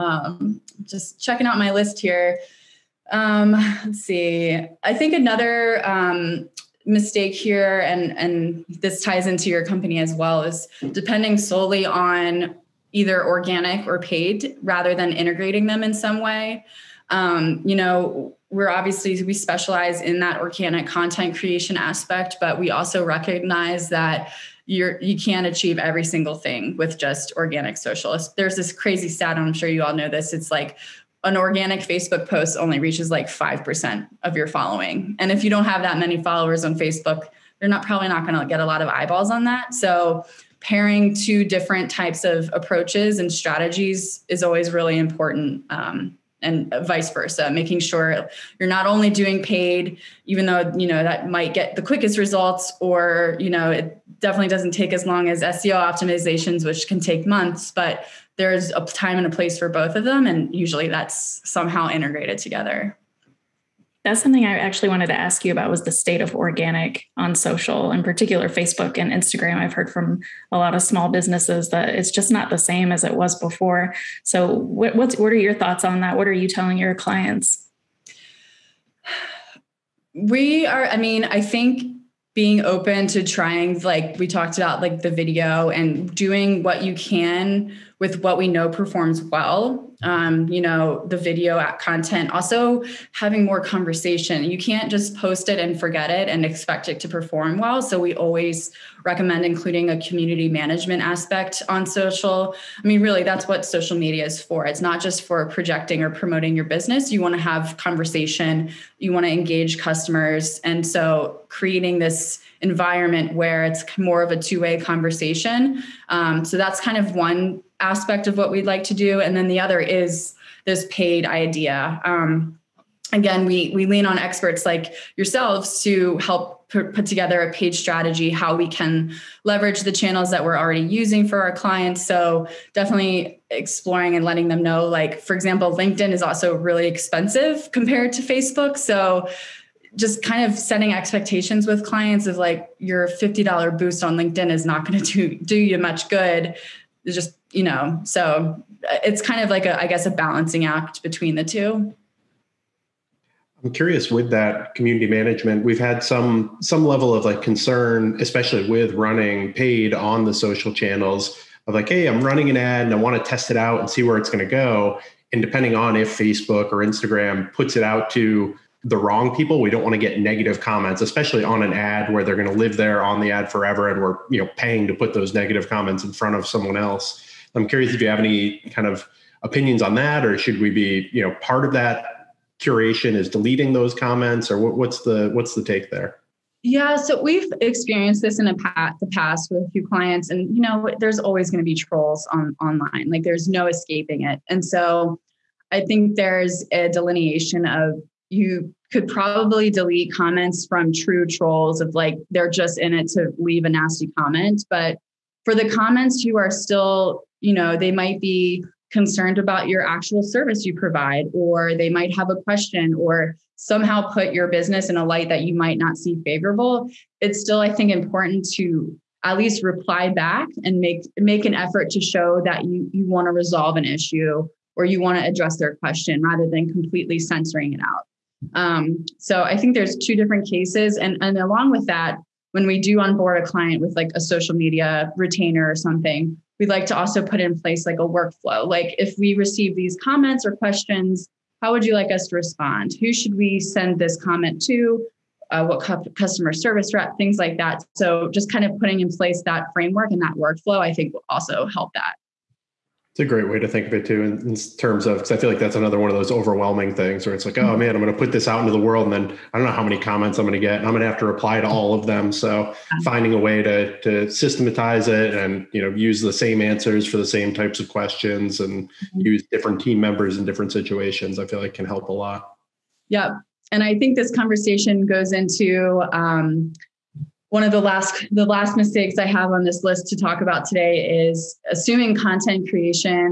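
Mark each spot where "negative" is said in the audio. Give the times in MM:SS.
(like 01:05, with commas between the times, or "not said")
02:50, 02:55.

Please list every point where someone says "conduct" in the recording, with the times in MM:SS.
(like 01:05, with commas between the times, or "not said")
not said.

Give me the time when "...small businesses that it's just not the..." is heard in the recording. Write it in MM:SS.
01:10.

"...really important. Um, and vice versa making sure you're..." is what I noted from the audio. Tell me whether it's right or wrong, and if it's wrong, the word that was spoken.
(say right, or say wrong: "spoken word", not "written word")
right.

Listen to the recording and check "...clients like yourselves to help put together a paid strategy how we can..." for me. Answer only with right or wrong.
wrong.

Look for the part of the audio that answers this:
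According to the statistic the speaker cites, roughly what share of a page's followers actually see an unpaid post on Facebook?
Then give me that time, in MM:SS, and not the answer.
00:33.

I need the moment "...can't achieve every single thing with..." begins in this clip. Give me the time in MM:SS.
00:25.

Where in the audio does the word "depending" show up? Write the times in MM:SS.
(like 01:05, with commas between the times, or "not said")
00:10, 02:45.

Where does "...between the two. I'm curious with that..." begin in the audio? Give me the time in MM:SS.
02:31.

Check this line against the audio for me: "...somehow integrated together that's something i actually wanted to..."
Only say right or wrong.
right.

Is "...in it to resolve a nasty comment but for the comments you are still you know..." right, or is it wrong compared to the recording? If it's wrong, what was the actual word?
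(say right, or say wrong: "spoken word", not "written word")
wrong: "leave", not "resolve".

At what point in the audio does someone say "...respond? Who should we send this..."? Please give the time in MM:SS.
04:02.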